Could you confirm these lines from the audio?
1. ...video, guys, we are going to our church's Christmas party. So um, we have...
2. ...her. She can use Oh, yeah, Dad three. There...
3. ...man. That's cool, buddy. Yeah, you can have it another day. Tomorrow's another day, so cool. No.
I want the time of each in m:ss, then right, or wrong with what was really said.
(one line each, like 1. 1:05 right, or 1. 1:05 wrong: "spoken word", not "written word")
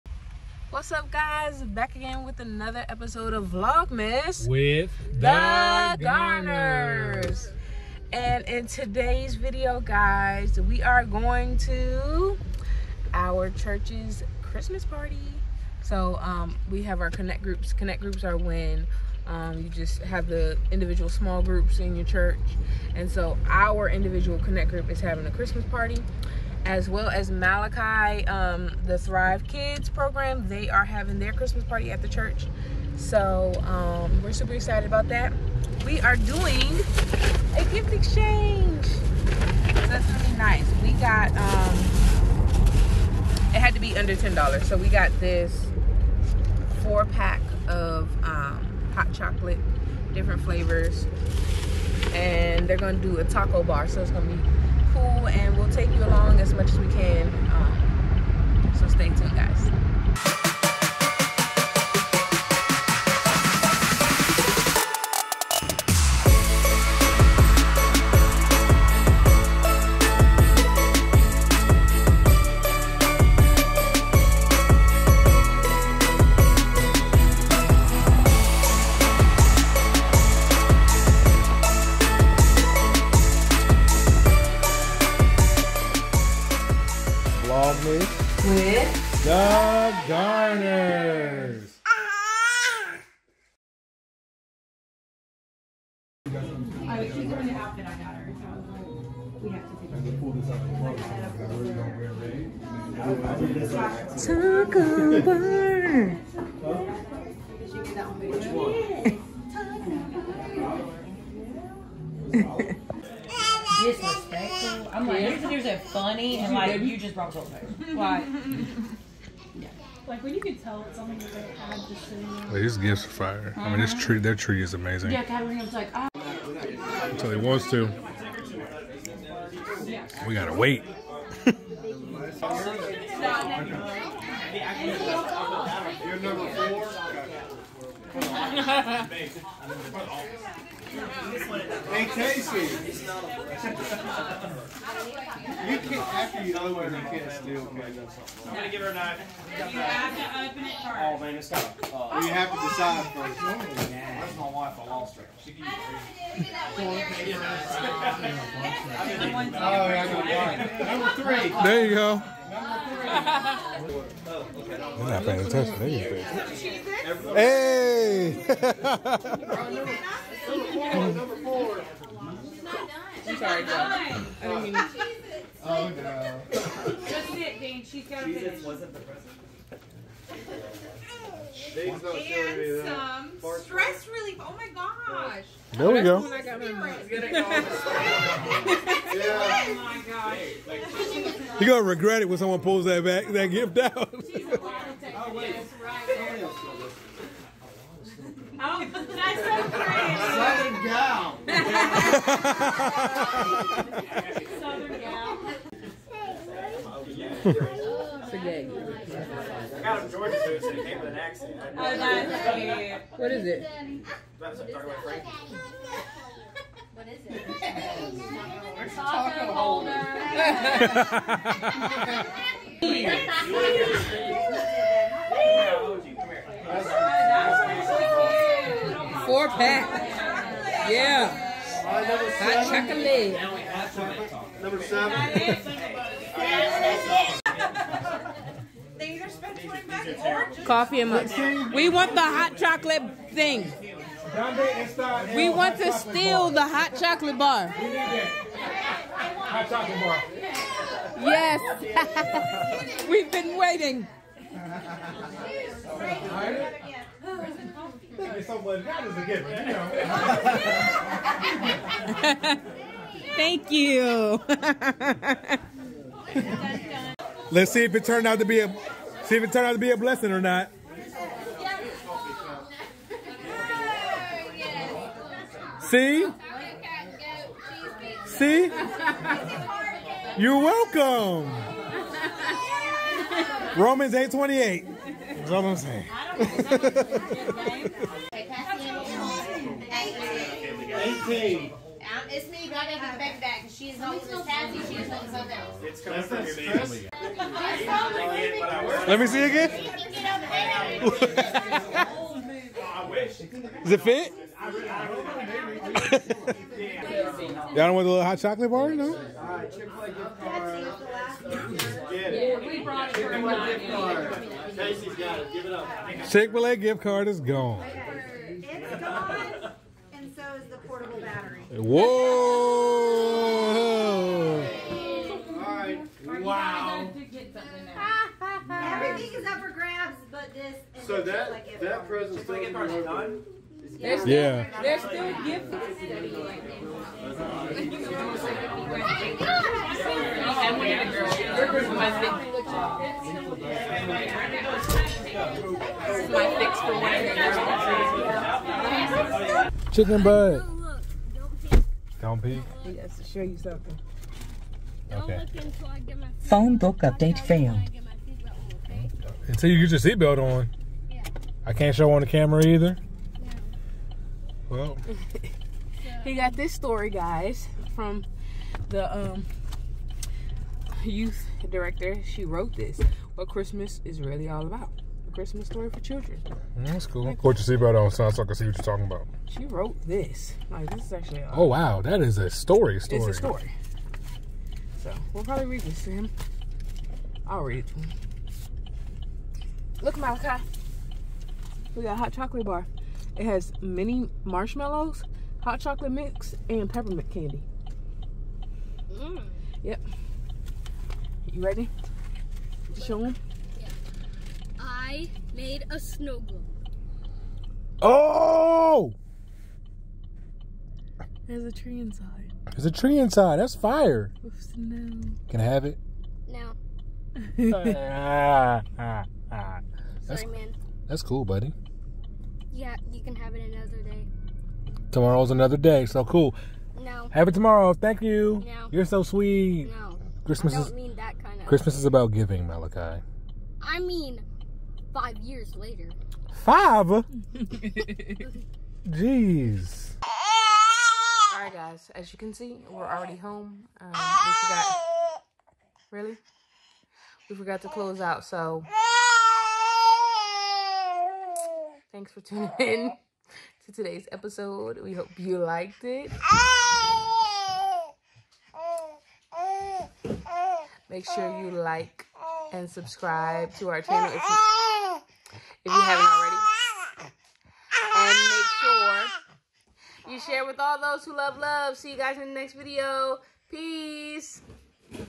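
1. 0:09 right
2. 2:35 wrong: "Number", not "Dad"
3. 7:00 right.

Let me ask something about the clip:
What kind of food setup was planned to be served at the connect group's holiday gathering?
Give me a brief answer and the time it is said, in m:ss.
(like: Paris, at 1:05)
taco bar, at 0:53.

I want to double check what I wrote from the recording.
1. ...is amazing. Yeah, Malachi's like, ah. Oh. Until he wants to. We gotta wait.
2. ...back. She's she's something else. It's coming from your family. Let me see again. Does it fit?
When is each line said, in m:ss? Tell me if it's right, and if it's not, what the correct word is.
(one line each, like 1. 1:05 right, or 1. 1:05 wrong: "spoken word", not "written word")
1. 2:04 wrong: "Catarina", not "Malachi"
2. 4:53 right.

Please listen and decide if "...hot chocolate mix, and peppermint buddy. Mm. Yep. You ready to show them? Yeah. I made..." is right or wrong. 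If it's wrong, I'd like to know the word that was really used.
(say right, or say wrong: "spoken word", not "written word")
wrong: "candy", not "buddy".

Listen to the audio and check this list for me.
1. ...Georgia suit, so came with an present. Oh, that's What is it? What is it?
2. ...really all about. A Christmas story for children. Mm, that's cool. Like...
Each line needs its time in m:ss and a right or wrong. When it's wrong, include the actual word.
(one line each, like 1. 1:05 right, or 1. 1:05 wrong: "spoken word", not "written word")
1. 3:30 wrong: "accent", not "present"
2. 6:14 right.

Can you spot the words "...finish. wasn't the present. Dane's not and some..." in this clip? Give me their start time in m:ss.
2:58.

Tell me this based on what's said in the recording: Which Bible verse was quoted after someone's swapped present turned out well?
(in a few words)
Romans 8:28.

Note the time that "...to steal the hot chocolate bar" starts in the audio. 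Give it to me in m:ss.
4:05.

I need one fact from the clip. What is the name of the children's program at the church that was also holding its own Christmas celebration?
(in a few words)
Thrive Kids.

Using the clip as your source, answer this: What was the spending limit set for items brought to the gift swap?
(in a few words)
$10.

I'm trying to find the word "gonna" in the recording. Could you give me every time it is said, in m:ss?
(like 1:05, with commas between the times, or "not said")
2:28, 3:11.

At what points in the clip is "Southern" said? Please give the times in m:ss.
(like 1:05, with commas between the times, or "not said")
3:19, 3:24.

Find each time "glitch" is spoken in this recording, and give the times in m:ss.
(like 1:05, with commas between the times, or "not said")
not said.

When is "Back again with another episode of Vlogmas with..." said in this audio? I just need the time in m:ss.
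0:01.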